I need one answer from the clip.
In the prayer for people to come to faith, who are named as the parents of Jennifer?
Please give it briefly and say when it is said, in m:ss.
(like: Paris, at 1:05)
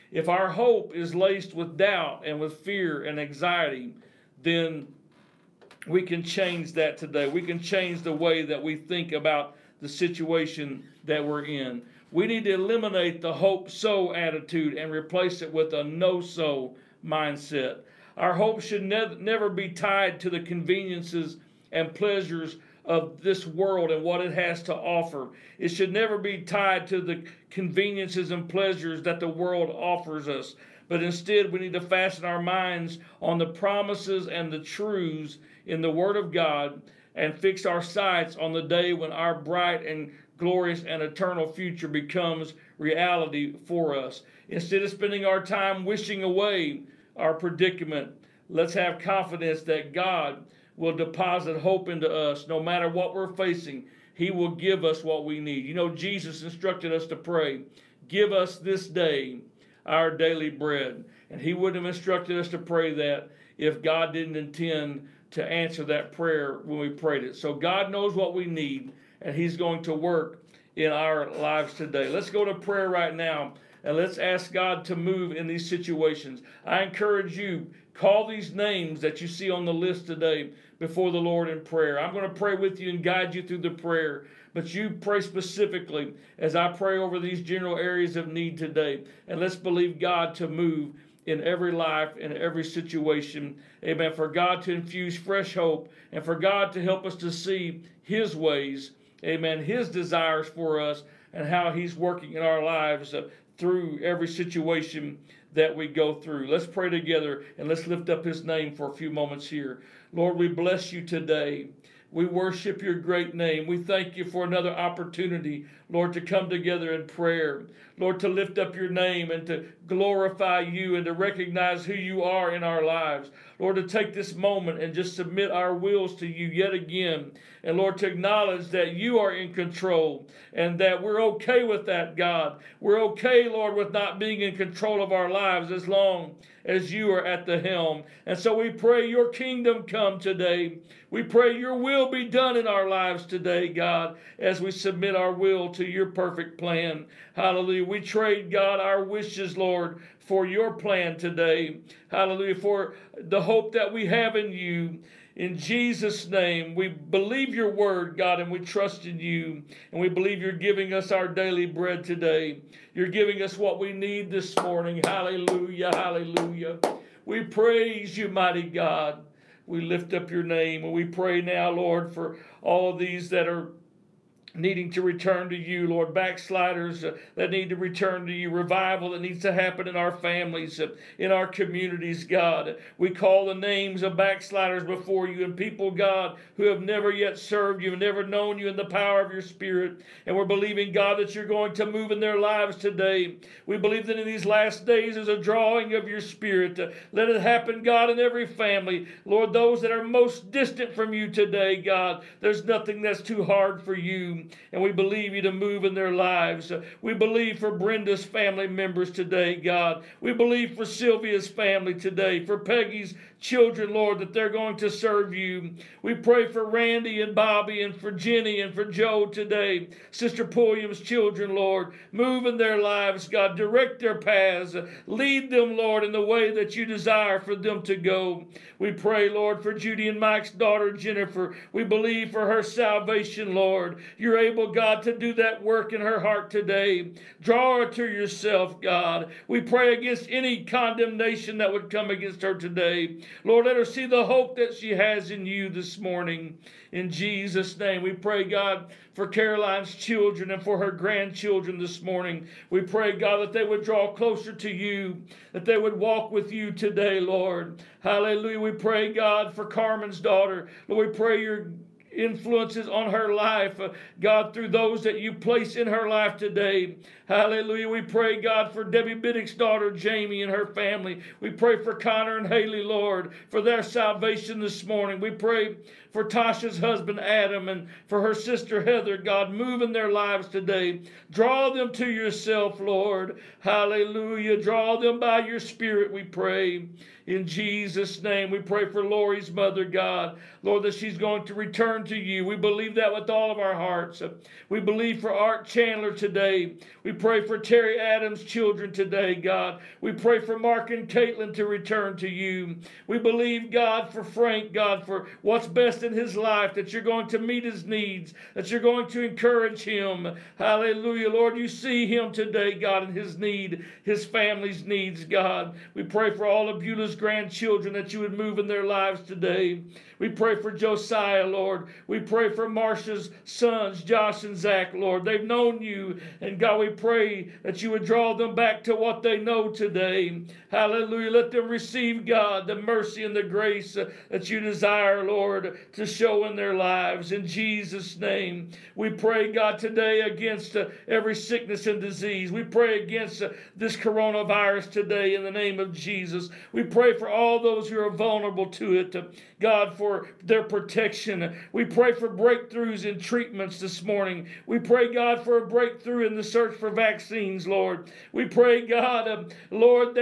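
Judy and Mike, at 3:49.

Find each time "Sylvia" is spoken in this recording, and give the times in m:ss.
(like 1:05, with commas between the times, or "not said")
3:30.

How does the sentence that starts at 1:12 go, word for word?
Let's go to prayer right now and let's ask God to move in these situations.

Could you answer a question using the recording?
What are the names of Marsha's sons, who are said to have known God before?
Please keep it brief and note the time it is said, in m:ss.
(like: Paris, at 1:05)
Josh and Zach, at 5:24.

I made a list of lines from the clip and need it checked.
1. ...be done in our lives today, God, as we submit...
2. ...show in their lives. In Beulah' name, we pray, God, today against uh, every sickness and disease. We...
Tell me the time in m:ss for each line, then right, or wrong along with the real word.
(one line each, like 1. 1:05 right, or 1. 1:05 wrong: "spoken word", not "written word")
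1. 2:22 right
2. 5:36 wrong: "Jesus", not "Beulah".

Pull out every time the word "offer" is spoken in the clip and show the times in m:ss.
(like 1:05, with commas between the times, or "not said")
0:24, 0:29.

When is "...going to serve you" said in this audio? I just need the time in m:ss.
3:34.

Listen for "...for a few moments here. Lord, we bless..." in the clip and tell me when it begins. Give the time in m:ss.
1:48.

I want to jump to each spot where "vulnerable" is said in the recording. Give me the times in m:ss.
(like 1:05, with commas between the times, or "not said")
5:48.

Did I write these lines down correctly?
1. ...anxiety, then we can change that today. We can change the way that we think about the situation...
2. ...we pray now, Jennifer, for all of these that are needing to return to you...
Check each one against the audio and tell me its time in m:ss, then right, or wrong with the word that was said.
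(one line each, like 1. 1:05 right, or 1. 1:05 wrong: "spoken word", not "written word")
1. 0:03 right
2. 2:50 wrong: "Lord", not "Jennifer".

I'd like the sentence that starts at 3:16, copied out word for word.
Uh, let it happen, God, in every family.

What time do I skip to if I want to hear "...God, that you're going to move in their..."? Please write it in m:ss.
3:10.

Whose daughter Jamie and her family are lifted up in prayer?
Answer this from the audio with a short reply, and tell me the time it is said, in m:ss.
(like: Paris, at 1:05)
Debbie Biddick, at 4:28.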